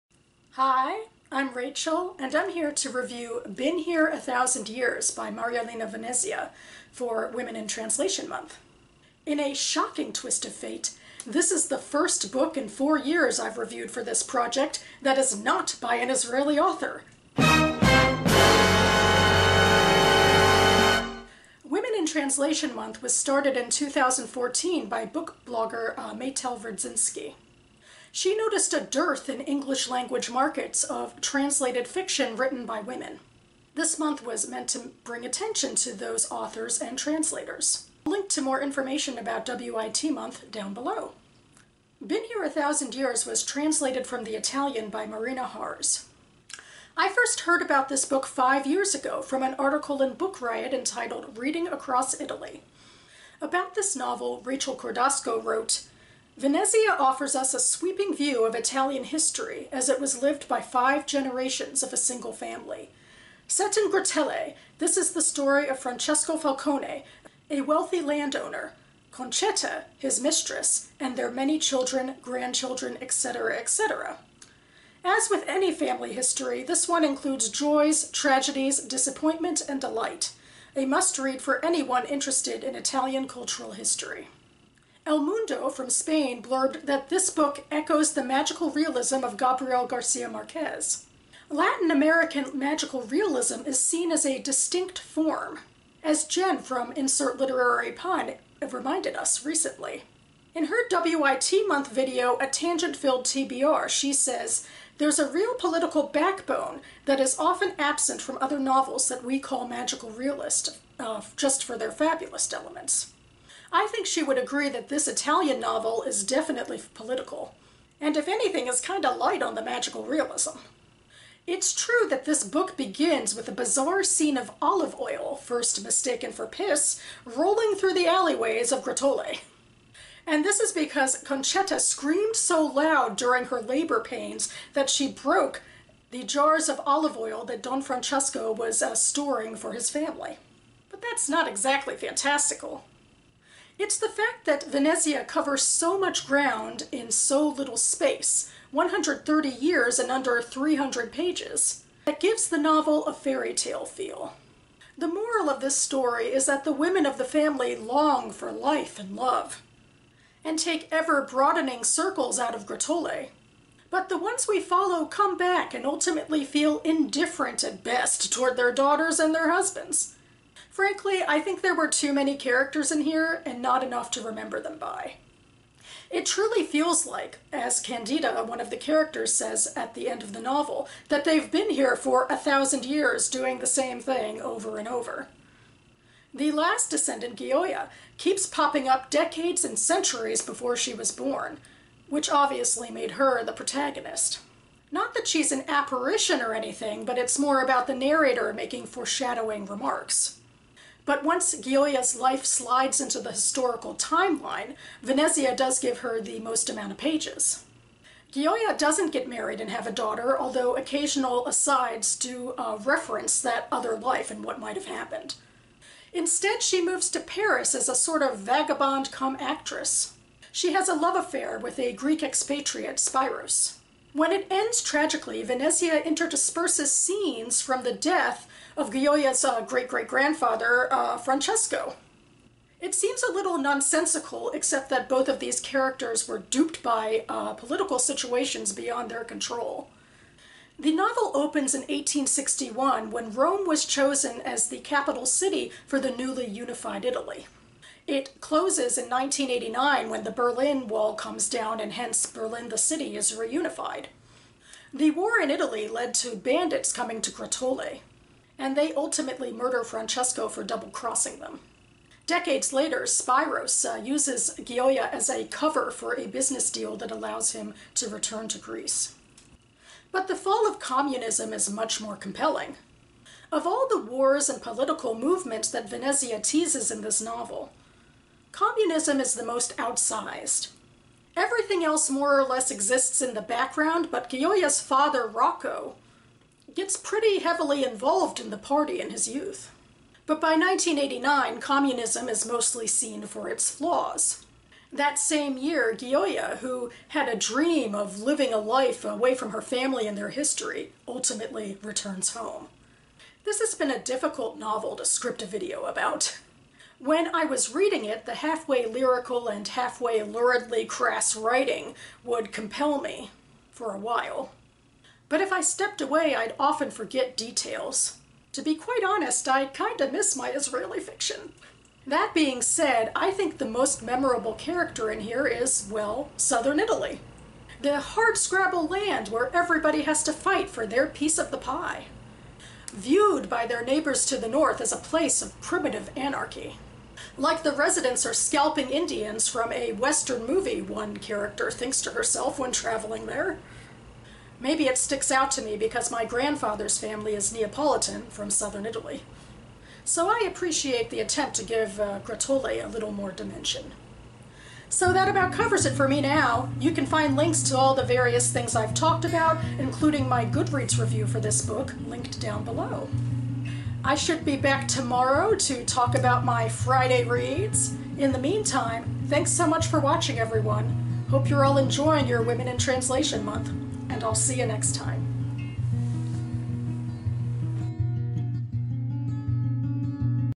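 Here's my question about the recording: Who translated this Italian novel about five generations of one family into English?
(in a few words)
Marina Harss.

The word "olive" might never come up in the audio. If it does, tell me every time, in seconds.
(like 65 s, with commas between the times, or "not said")
124 s, 136 s.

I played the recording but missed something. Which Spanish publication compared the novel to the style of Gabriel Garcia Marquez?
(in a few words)
El Mundo.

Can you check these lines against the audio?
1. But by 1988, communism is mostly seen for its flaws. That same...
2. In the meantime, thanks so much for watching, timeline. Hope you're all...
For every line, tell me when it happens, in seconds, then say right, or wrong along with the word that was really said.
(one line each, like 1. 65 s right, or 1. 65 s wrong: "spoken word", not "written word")
1. 290 s wrong: "1989", not "1988"
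2. 368 s wrong: "everyone", not "timeline".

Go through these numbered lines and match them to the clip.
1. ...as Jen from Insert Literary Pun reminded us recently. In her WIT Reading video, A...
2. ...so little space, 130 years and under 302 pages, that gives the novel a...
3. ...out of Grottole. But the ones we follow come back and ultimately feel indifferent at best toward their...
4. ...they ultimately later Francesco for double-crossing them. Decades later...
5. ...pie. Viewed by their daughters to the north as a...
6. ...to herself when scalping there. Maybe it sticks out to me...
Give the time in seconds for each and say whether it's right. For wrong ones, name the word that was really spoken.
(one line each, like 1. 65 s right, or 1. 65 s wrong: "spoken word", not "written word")
1. 96 s wrong: "Month", not "Reading"
2. 147 s wrong: "300", not "302"
3. 162 s right
4. 258 s wrong: "murder", not "later"
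5. 331 s wrong: "neighbors", not "daughters"
6. 342 s wrong: "traveling", not "scalping".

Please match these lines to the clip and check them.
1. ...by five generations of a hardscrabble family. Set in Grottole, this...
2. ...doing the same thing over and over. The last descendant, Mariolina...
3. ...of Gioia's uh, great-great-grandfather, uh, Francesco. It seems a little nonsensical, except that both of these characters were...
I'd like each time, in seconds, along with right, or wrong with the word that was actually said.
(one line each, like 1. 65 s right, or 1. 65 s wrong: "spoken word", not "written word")
1. 60 s wrong: "single", not "hardscrabble"
2. 183 s wrong: "Gioia", not "Mariolina"
3. 228 s right.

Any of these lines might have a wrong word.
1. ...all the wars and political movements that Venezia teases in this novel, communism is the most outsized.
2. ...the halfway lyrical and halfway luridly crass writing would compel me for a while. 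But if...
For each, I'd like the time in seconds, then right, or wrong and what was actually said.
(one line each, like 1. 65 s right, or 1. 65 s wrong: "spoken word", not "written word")
1. 273 s right
2. 308 s right.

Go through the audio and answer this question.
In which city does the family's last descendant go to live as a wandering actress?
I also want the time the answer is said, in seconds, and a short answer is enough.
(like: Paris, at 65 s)
Paris, at 217 s.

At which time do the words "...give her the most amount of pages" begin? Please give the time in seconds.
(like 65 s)
205 s.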